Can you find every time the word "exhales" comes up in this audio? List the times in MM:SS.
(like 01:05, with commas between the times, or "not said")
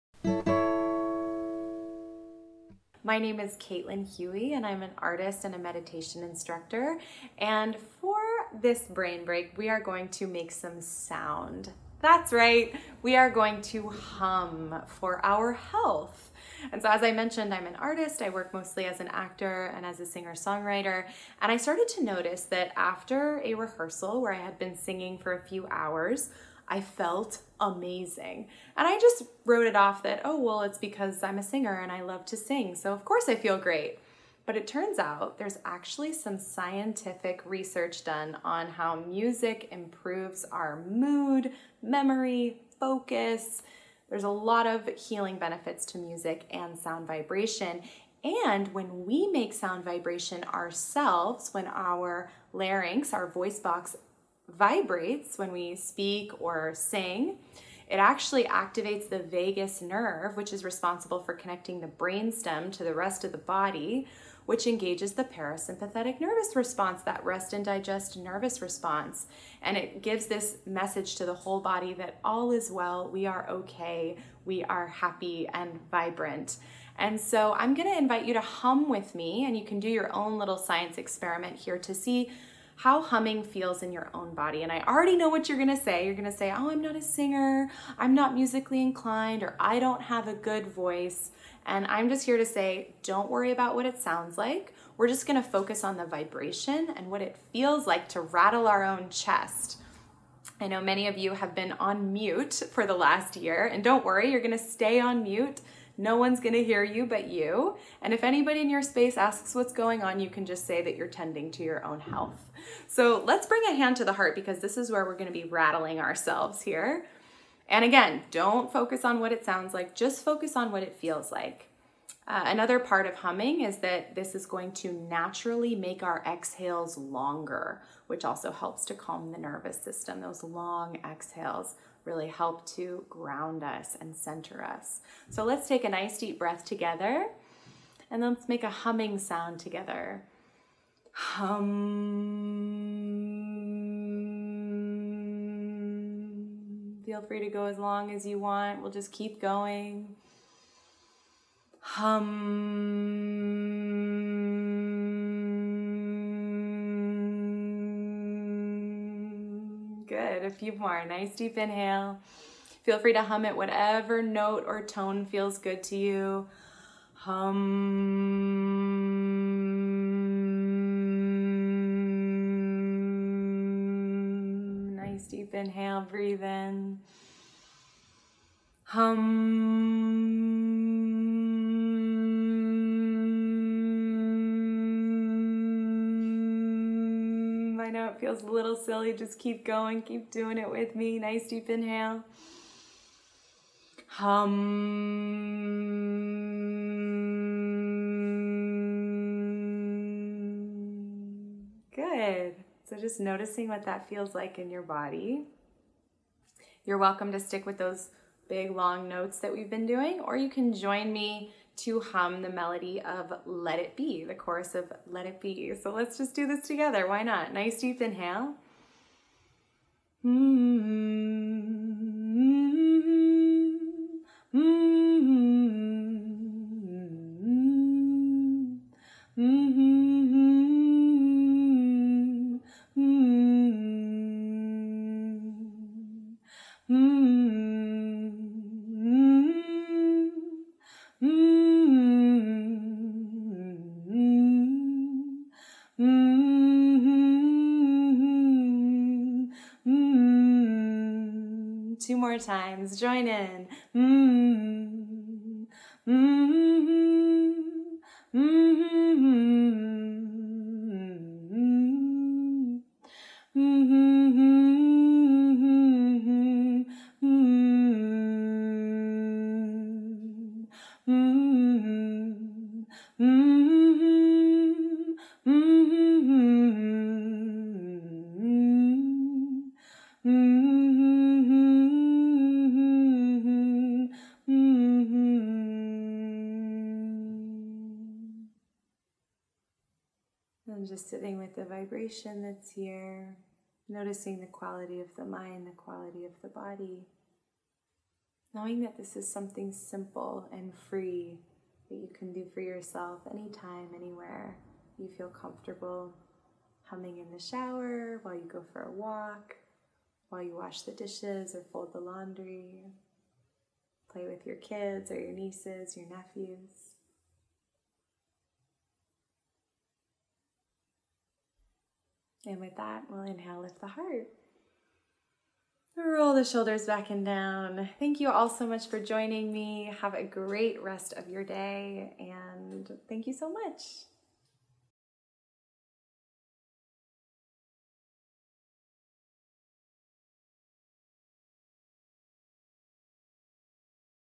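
02:06, 02:11.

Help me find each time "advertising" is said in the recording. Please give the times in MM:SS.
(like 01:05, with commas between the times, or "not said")
not said.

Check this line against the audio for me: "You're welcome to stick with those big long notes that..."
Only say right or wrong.
right.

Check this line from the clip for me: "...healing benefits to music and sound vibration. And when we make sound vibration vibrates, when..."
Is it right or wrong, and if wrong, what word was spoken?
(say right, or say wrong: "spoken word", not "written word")
wrong: "ourselves", not "vibrates".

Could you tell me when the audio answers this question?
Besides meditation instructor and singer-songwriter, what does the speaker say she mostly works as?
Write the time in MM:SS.
00:19.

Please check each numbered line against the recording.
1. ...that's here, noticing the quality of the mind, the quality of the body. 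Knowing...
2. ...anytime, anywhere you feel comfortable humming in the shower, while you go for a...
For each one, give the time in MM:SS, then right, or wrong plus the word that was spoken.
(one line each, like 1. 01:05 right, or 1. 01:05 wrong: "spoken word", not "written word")
1. 04:52 right
2. 05:03 right.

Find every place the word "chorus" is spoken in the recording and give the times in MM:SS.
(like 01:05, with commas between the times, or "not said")
03:34.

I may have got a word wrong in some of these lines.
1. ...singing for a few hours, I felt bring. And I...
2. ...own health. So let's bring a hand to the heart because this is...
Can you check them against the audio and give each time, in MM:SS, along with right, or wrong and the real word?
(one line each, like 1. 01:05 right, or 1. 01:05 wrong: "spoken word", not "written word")
1. 00:24 wrong: "amazing", not "bring"
2. 01:51 right.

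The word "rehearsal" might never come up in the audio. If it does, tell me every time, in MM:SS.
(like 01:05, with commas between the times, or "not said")
00:23.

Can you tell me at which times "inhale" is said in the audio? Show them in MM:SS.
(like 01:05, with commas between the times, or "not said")
02:41, 02:55, 03:11, 03:38, 05:23.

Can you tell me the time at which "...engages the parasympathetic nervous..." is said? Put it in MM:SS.
01:04.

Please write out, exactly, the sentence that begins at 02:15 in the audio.
So let's take a nice deep breath together and let's make a humming sound together.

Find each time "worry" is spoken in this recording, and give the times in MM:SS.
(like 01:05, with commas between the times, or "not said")
01:33, 01:44.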